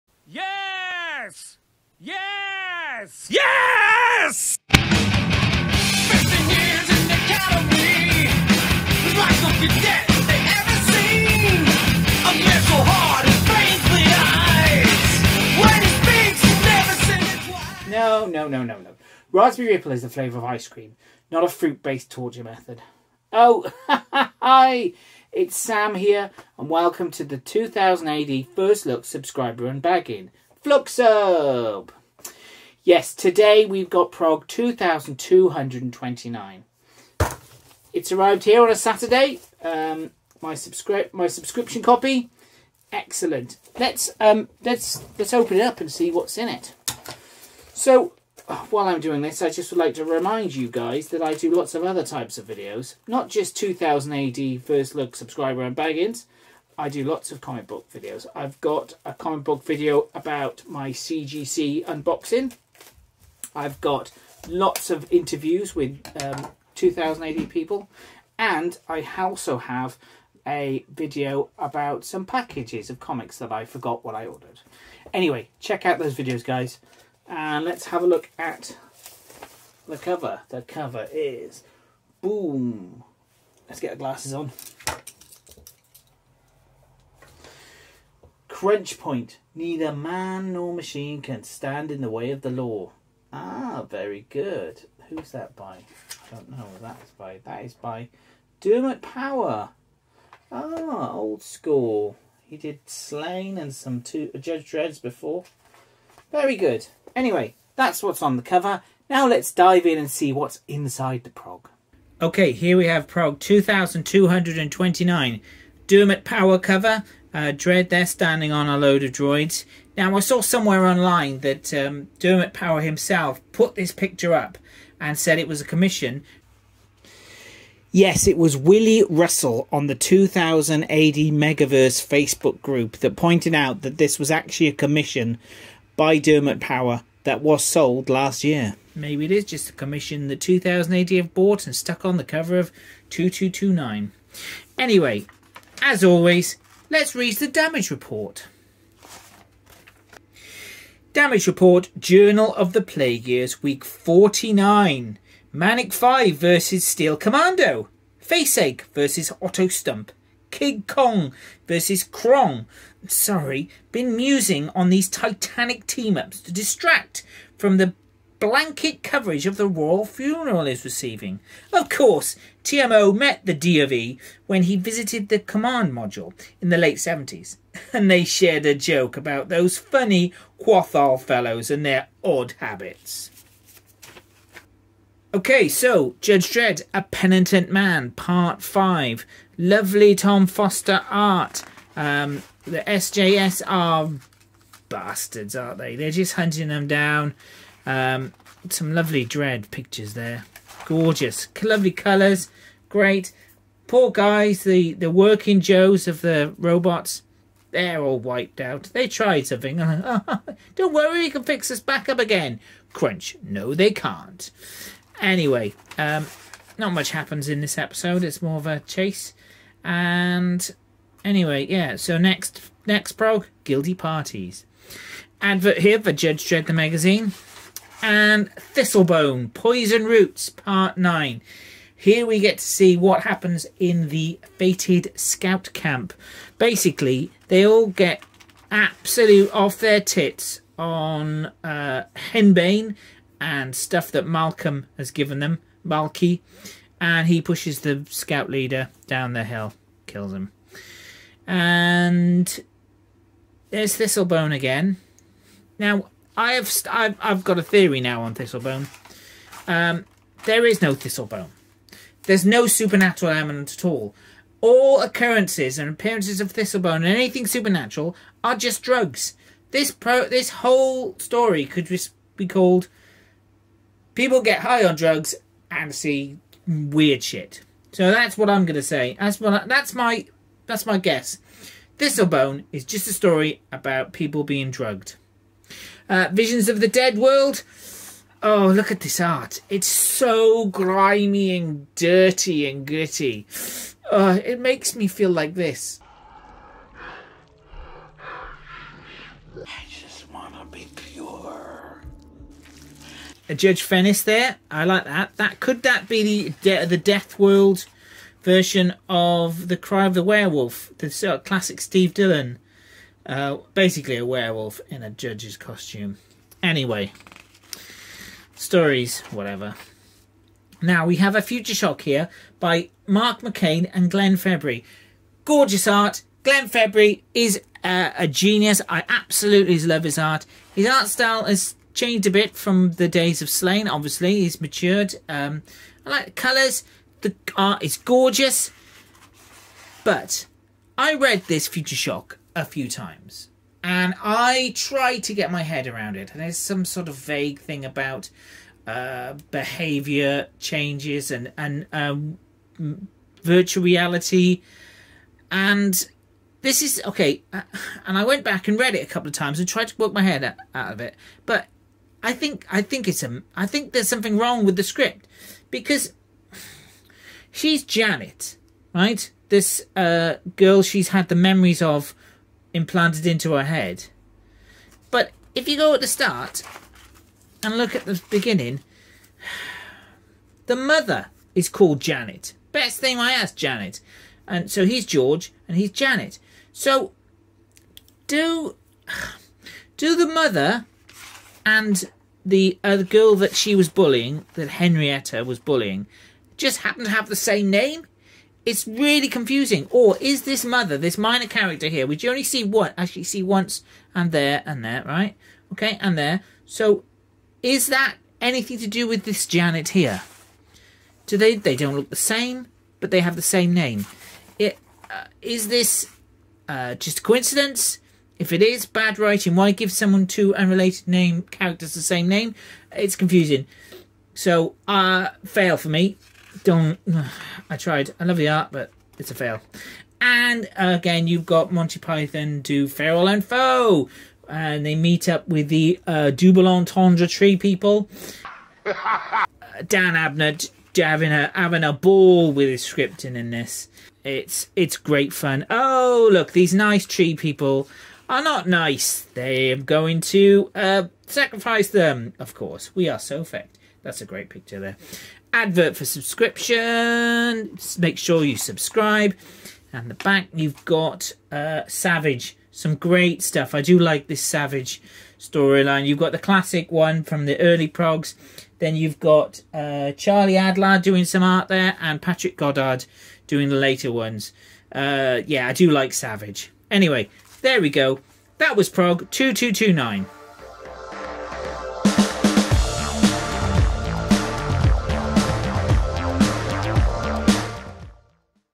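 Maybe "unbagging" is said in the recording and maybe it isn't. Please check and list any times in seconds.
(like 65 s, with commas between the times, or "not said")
29 s, 55 s.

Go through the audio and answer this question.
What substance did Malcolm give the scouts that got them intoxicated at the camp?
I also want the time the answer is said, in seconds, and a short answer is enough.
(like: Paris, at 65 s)
Henbane, at 242 s.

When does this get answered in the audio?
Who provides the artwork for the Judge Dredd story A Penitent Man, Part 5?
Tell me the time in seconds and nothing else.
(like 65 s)
190 s.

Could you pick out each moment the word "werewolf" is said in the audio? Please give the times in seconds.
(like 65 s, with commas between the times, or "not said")
310 s, 314 s.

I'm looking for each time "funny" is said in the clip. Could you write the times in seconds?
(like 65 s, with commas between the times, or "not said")
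179 s.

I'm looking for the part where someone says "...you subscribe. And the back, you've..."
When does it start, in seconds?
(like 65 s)
458 s.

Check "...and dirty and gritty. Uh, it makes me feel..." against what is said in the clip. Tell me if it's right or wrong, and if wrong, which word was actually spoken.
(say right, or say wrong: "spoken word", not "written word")
right.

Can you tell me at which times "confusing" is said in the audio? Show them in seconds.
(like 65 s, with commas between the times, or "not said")
399 s, 423 s.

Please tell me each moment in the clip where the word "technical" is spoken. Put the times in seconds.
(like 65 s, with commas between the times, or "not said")
not said.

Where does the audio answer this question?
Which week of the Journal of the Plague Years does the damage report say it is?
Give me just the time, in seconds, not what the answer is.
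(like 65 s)
153 s.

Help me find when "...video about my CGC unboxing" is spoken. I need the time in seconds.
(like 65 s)
59 s.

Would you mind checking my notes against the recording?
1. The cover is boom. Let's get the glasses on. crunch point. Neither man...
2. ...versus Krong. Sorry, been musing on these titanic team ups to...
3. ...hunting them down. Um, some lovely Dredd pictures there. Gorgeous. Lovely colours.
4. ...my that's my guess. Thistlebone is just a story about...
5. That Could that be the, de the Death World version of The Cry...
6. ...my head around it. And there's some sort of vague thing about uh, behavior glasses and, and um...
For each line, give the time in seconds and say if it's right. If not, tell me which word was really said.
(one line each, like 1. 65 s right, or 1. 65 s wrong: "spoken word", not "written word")
1. 80 s right
2. 161 s right
3. 196 s right
4. 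279 s right
5. 305 s right
6. 345 s wrong: "changes", not "glasses".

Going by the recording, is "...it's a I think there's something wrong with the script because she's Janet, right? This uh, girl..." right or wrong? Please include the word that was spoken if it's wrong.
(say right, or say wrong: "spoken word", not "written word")
right.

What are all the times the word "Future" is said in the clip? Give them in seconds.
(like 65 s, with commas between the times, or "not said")
321 s, 341 s.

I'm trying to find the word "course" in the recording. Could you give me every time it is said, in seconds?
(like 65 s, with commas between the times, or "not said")
171 s, 452 s.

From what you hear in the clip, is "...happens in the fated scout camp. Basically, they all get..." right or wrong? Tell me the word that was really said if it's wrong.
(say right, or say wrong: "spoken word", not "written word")
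right.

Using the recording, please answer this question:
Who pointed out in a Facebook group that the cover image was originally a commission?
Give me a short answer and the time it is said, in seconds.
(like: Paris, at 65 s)
Willie Russell, at 128 s.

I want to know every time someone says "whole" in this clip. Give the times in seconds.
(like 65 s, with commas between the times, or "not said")
270 s.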